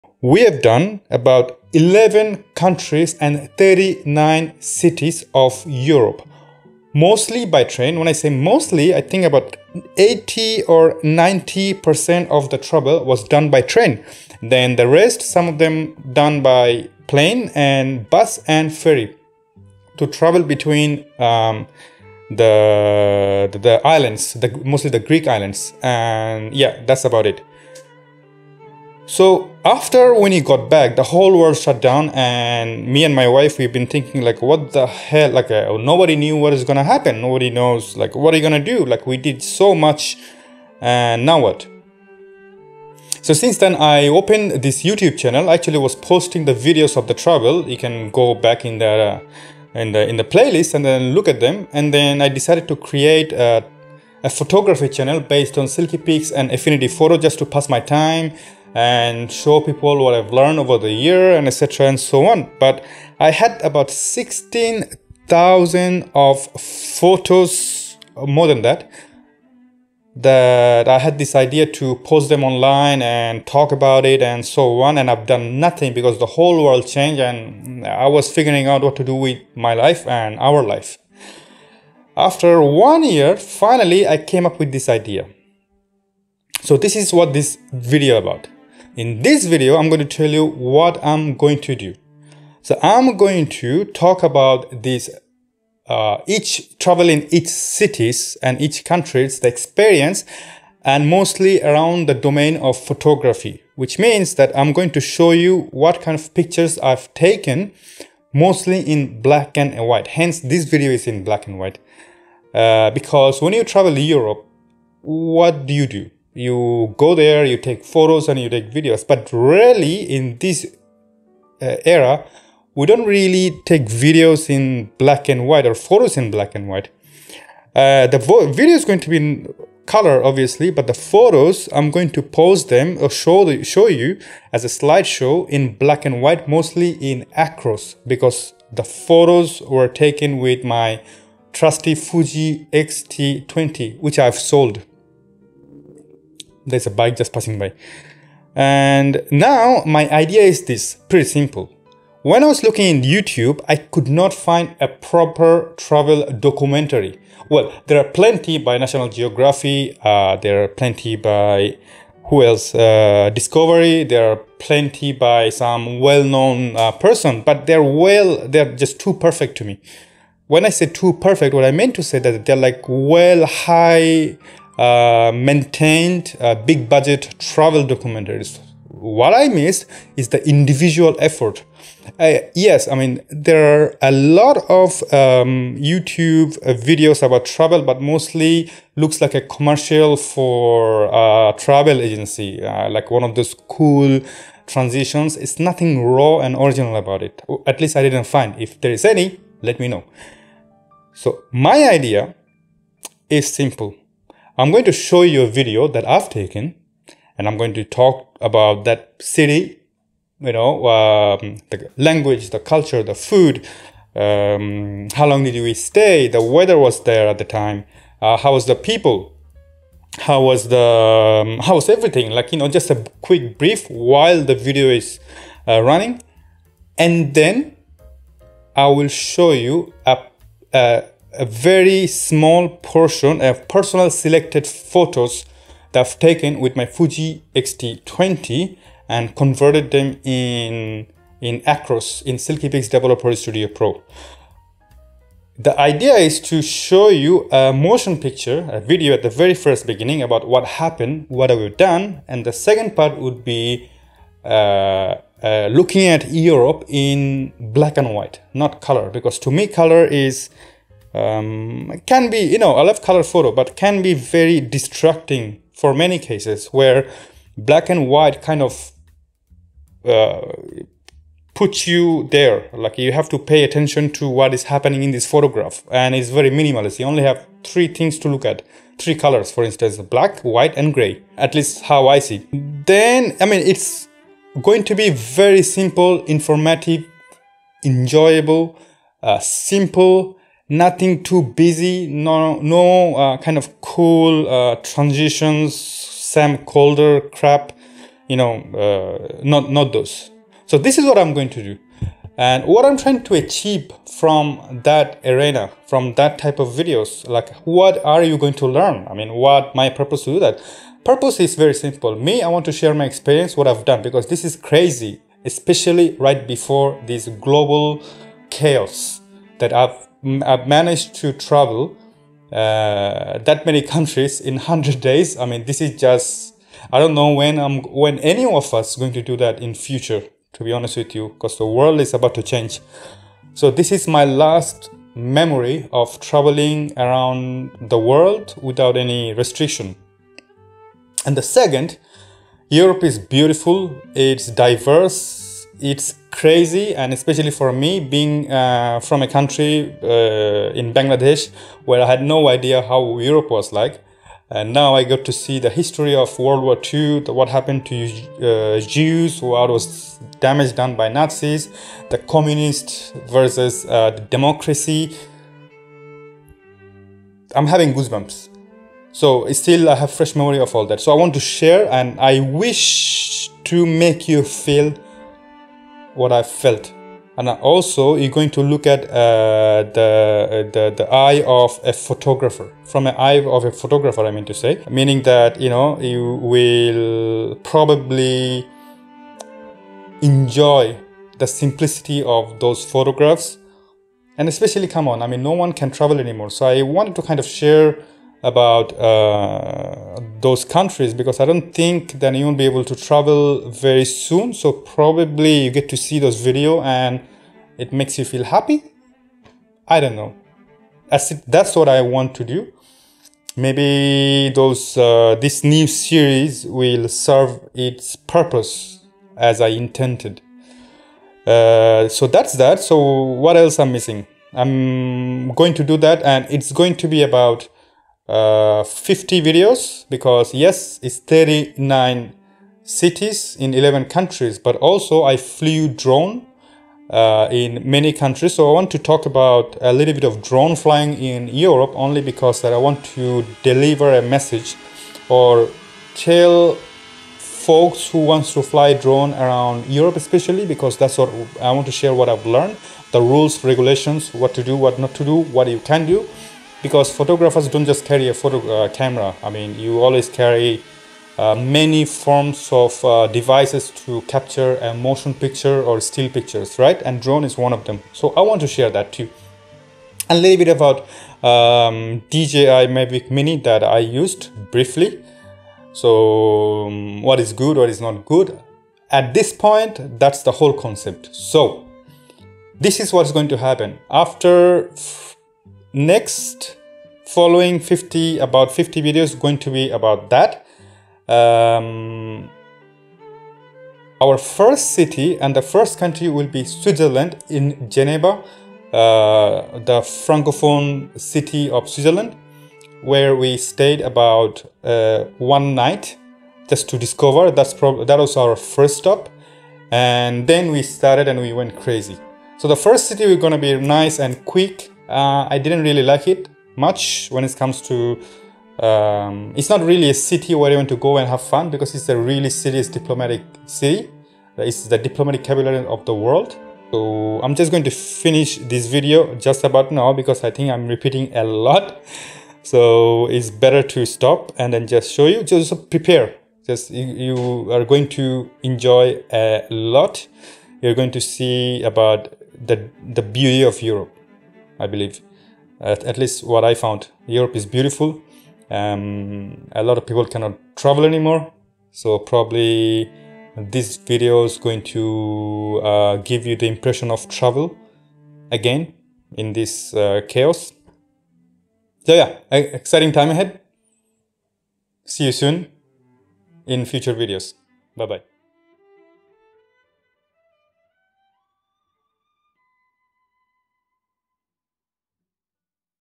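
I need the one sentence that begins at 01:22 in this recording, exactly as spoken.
After one year, finally I came up with this idea.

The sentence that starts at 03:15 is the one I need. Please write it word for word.
It's nothing raw and original about it.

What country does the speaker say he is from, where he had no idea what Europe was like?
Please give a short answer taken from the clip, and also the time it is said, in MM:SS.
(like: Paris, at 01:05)
Bangladesh, at 05:50.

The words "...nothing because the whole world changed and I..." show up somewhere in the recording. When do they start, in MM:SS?
01:15.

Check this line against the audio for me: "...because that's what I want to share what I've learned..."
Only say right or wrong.
right.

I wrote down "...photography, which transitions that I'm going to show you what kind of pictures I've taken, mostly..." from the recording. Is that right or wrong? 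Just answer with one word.
wrong.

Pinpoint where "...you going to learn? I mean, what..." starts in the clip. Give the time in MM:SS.
05:08.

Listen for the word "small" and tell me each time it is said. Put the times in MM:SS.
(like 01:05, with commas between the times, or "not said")
03:52.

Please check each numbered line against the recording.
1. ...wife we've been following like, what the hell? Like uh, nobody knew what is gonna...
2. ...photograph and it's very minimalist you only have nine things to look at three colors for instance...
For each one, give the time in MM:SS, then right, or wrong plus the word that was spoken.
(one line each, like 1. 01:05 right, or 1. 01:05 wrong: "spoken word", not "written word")
1. 00:33 wrong: "thinking", not "following"
2. 04:35 wrong: "three", not "nine".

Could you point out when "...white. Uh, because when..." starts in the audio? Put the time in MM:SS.
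01:51.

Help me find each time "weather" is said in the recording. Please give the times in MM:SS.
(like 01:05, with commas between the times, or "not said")
03:36.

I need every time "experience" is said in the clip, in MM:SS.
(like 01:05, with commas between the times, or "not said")
01:39, 05:13.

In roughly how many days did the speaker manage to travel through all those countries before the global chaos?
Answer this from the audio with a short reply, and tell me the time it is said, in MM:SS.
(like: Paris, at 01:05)
100, at 05:24.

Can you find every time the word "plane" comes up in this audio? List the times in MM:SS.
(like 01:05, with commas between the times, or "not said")
00:17.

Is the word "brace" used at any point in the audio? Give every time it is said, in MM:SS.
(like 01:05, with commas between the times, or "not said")
not said.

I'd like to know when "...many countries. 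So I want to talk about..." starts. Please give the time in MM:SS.
07:17.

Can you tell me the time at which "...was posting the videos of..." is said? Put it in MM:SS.
00:45.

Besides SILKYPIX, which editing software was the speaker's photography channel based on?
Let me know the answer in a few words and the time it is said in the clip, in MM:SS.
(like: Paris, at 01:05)
Affinity Photo, at 00:56.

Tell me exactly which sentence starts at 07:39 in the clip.
I mean, you always carry uh, many forms of uh, devices to capture a motion picture or still pictures, right?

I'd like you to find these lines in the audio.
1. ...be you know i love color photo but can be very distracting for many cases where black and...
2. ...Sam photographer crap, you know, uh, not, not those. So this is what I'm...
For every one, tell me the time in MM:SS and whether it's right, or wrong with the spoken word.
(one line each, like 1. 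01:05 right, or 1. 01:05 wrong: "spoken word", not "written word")
1. 04:22 right
2. 04:55 wrong: "colder", not "photographer".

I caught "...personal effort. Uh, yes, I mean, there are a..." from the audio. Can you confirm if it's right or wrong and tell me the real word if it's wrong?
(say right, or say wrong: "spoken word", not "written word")
wrong: "individual", not "personal".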